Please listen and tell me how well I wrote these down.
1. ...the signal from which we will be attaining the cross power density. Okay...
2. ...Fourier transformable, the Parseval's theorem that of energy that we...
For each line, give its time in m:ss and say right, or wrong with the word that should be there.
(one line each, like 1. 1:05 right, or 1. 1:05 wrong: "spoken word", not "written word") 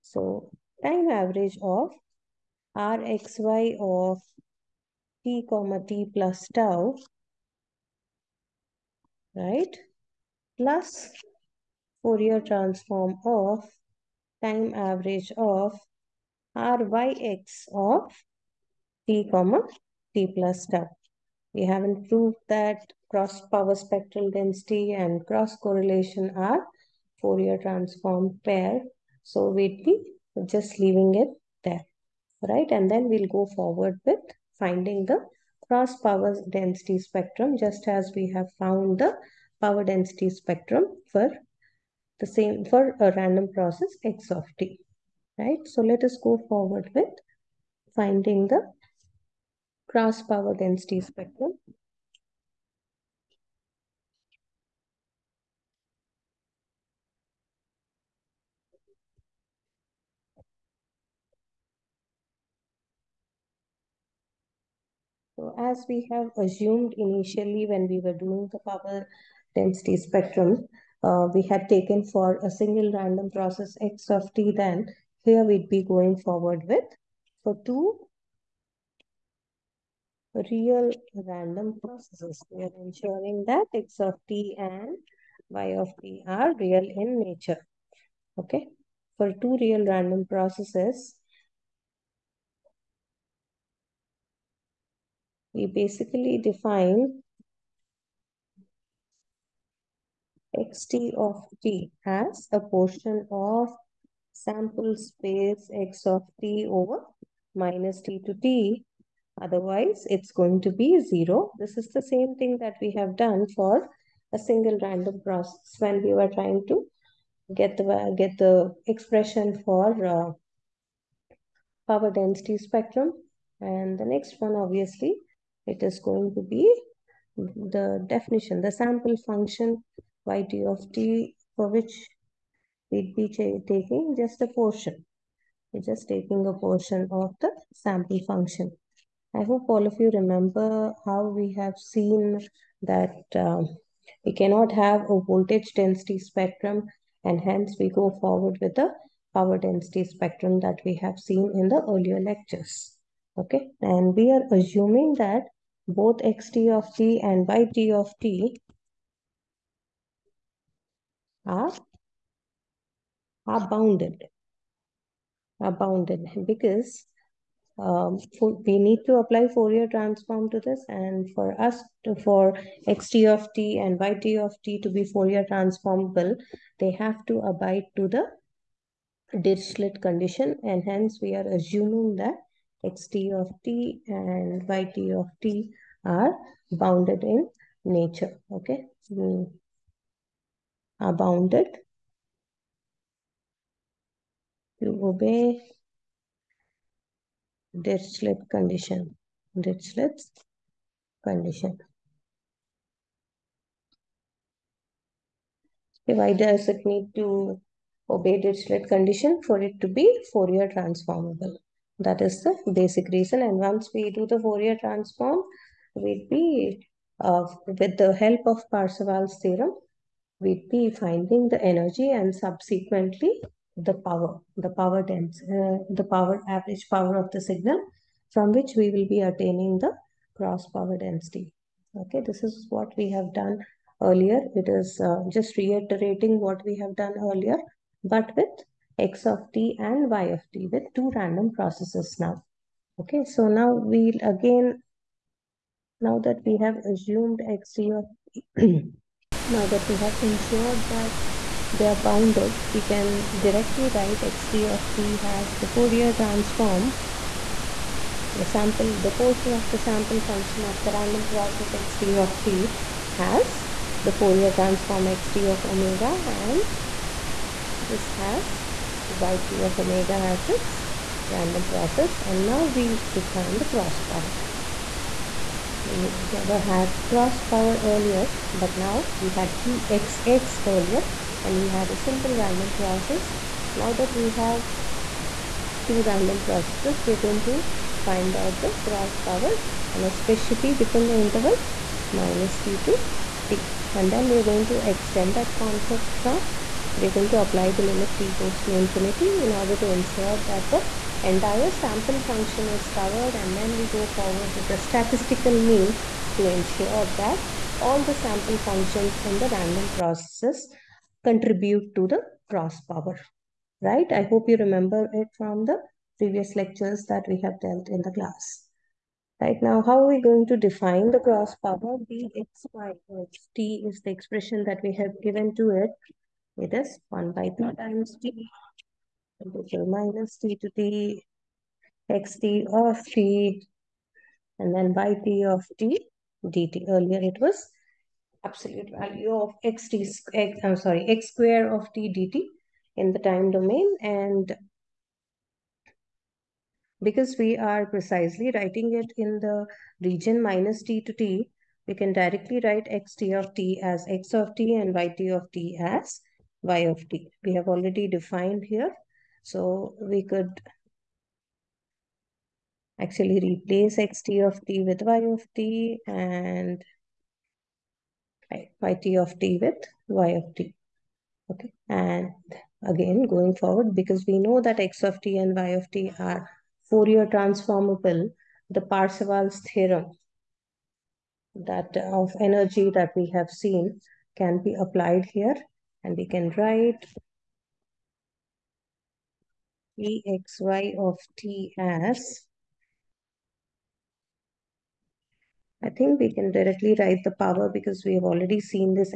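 1. 3:47 right
2. 6:16 right.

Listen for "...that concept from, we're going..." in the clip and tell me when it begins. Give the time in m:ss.
4:55.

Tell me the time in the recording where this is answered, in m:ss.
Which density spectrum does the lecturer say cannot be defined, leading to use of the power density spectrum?
2:25.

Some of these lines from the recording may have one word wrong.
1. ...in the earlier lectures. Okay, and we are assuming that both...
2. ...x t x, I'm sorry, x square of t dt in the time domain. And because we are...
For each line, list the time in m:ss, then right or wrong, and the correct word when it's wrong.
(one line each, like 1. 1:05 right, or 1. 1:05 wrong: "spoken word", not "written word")
1. 2:31 right
2. 5:39 right.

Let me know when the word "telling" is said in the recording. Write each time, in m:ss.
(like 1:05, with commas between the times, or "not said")
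not said.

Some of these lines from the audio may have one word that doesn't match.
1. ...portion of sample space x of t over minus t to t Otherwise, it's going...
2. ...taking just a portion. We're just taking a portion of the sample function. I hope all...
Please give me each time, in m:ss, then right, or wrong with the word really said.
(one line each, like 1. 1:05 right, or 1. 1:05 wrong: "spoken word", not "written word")
1. 1:42 right
2. 2:13 right.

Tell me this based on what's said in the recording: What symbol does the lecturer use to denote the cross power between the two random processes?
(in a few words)
Pxy.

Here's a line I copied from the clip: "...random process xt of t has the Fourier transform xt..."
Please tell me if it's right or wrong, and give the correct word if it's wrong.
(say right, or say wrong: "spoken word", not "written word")
right.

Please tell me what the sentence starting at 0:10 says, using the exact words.
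Plus Fourier transform of time average of ryx of t comma t plus tau.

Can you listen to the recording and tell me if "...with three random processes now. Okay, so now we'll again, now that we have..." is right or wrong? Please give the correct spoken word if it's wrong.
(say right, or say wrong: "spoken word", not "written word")
wrong: "two", not "three".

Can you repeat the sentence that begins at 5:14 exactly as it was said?
I hope you remember it from the previous lectures that we have dealt in the class.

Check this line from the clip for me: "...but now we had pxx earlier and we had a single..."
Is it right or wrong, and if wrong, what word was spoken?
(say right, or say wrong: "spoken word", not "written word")
right.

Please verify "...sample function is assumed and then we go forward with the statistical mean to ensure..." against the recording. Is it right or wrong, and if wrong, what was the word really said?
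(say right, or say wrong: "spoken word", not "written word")
wrong: "covered", not "assumed".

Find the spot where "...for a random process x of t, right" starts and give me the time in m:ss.
0:42.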